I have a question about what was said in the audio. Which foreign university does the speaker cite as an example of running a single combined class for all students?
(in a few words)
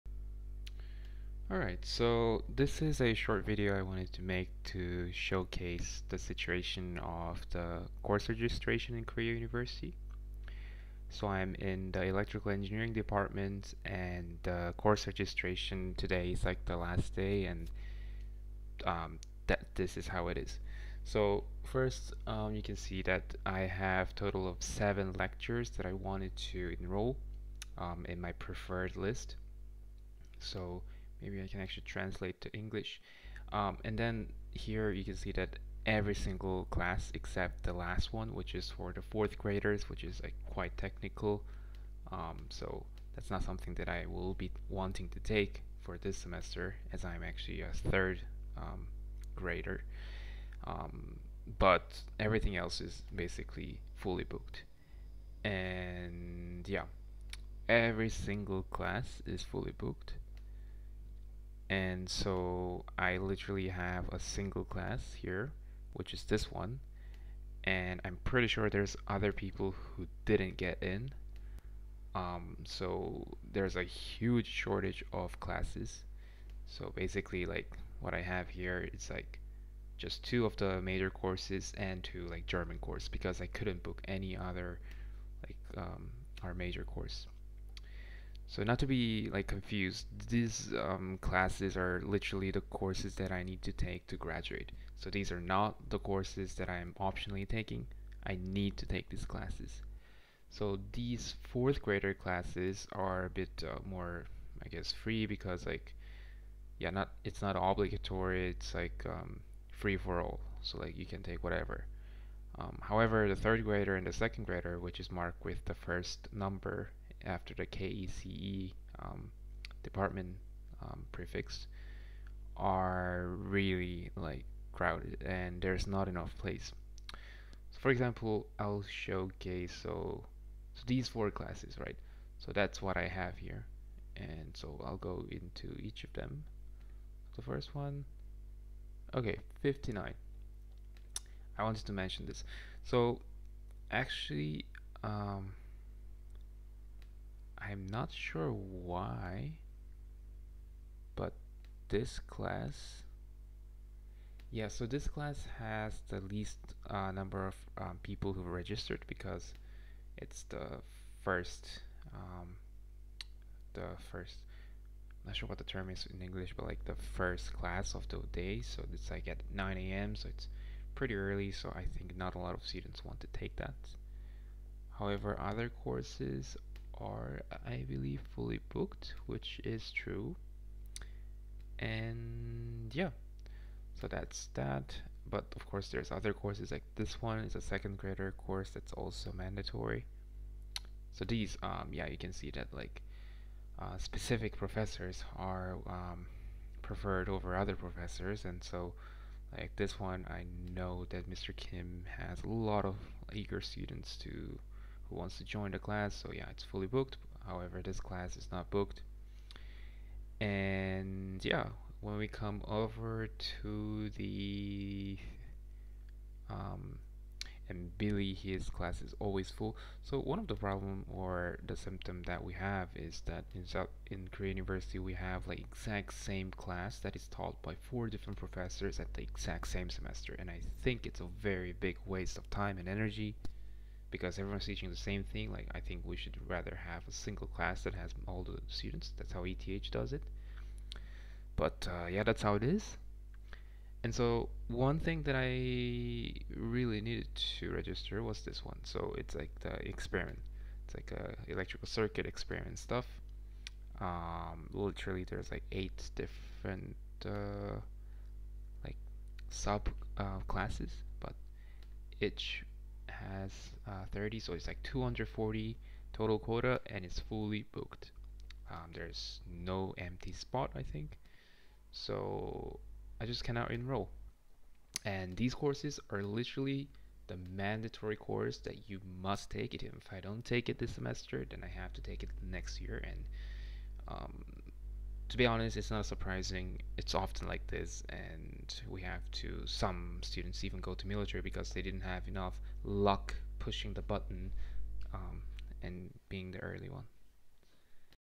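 ETH.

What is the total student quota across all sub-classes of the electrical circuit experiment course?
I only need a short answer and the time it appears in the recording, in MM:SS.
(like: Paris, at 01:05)
240, at 04:24.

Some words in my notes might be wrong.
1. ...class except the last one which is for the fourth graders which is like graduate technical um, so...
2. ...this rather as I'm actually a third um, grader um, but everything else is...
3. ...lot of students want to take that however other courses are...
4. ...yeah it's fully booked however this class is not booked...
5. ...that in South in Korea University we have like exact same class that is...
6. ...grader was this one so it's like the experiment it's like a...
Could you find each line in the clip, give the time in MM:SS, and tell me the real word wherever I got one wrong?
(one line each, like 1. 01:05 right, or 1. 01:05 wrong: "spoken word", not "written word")
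1. 00:36 wrong: "quite", not "graduate"
2. 00:45 wrong: "semester", not "rather"
3. 02:52 right
4. 03:26 right
5. 03:43 right
6. 04:07 wrong: "register", not "grader".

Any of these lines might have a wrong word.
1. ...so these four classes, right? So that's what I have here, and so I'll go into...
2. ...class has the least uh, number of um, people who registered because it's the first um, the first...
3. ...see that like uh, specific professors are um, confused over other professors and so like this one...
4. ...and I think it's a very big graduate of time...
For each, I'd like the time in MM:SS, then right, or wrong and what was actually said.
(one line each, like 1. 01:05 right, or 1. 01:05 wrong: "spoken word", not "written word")
1. 02:10 right
2. 02:35 right
3. 03:12 wrong: "preferred", not "confused"
4. 03:50 wrong: "waste", not "graduate".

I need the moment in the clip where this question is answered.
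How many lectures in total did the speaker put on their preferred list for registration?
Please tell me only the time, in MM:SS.
00:24.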